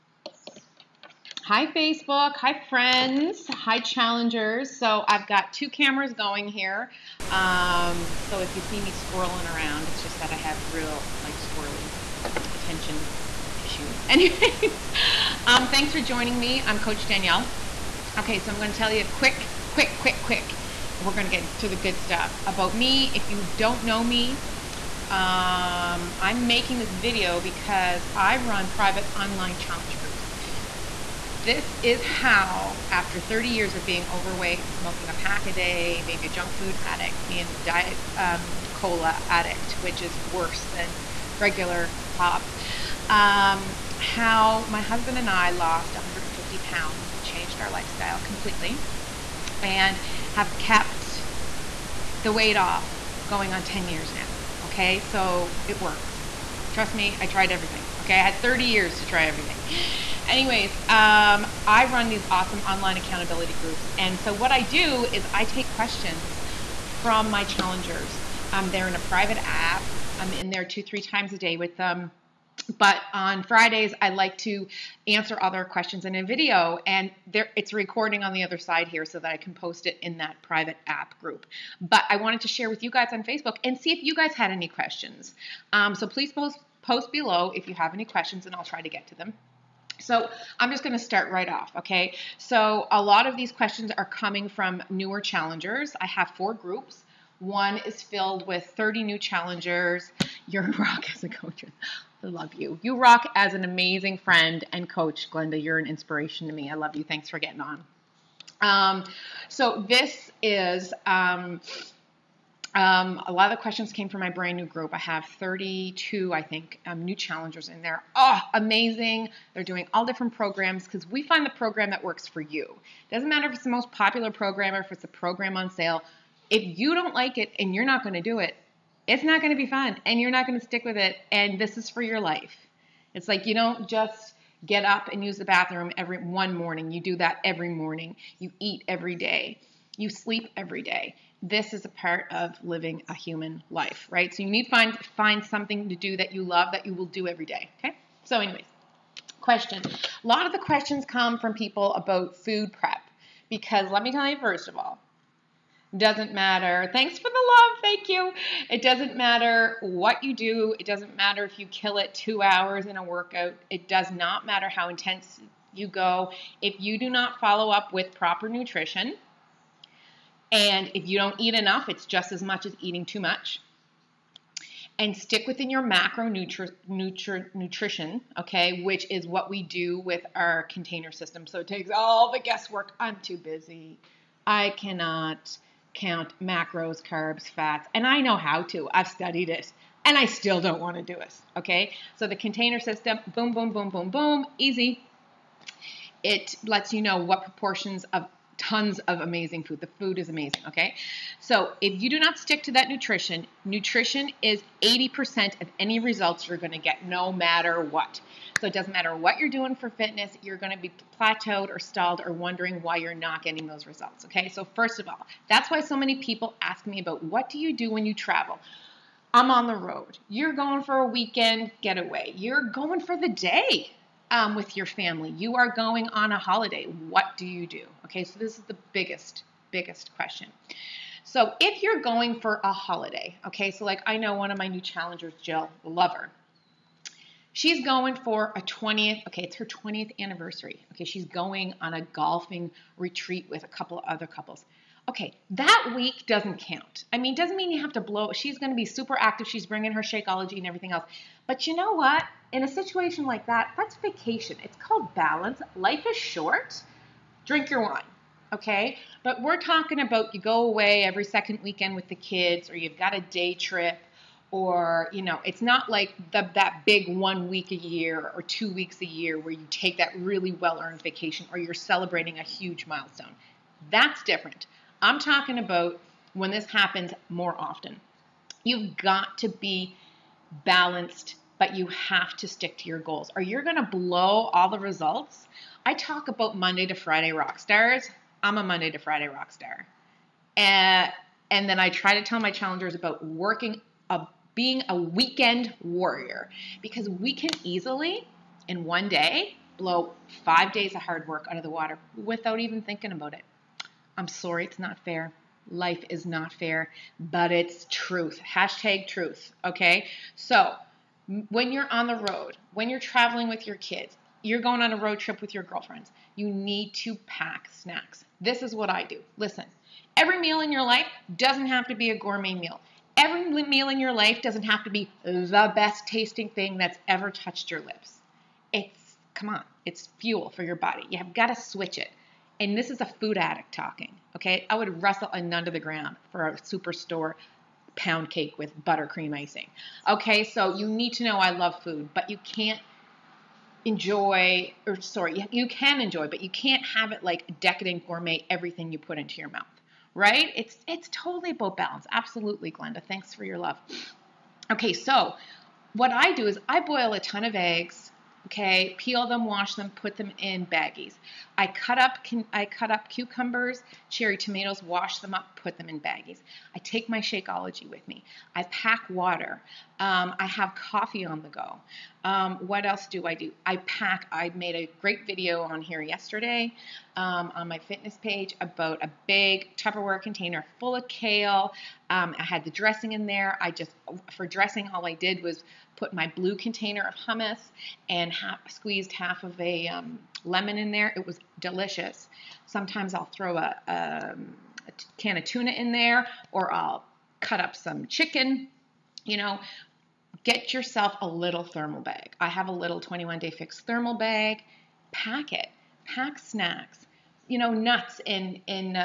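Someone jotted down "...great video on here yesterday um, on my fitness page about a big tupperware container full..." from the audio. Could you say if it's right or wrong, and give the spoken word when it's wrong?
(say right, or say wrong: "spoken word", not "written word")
right.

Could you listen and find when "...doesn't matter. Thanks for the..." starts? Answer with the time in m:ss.
2:35.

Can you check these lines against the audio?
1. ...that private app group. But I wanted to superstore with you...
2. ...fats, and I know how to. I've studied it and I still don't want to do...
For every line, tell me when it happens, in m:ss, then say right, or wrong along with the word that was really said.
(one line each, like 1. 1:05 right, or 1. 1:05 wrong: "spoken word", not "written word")
1. 1:20 wrong: "share", not "superstore"
2. 3:07 right.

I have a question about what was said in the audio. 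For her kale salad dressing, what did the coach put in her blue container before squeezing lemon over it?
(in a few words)
hummus.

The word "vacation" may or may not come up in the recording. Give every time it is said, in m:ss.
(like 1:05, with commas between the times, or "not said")
4:13, 4:31.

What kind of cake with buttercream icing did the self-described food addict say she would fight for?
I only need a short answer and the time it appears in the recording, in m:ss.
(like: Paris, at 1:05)
pound cake, at 5:37.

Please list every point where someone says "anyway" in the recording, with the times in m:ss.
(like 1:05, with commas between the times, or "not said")
0:14, 1:00, 2:28.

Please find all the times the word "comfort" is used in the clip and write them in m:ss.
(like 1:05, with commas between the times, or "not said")
not said.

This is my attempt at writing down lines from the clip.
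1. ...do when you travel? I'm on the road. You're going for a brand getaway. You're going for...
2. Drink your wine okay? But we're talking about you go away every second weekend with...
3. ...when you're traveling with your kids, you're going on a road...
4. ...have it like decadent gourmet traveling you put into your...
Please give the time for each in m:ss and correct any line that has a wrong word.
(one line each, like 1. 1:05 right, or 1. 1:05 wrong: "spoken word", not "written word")
1. 3:37 wrong: "weekend", not "brand"
2. 4:17 right
3. 5:12 right
4. 5:46 wrong: "everything", not "traveling".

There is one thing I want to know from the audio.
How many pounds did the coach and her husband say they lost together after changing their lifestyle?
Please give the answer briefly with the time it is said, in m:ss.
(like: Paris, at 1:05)
150, at 0:45.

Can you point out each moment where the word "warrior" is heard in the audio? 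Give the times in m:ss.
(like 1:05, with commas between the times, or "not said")
4:55.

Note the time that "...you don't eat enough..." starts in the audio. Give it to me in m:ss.
2:51.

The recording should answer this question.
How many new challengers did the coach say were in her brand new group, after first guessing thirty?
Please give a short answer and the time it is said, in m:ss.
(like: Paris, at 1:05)
32, at 1:55.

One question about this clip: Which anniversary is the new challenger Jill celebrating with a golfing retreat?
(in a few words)
20th.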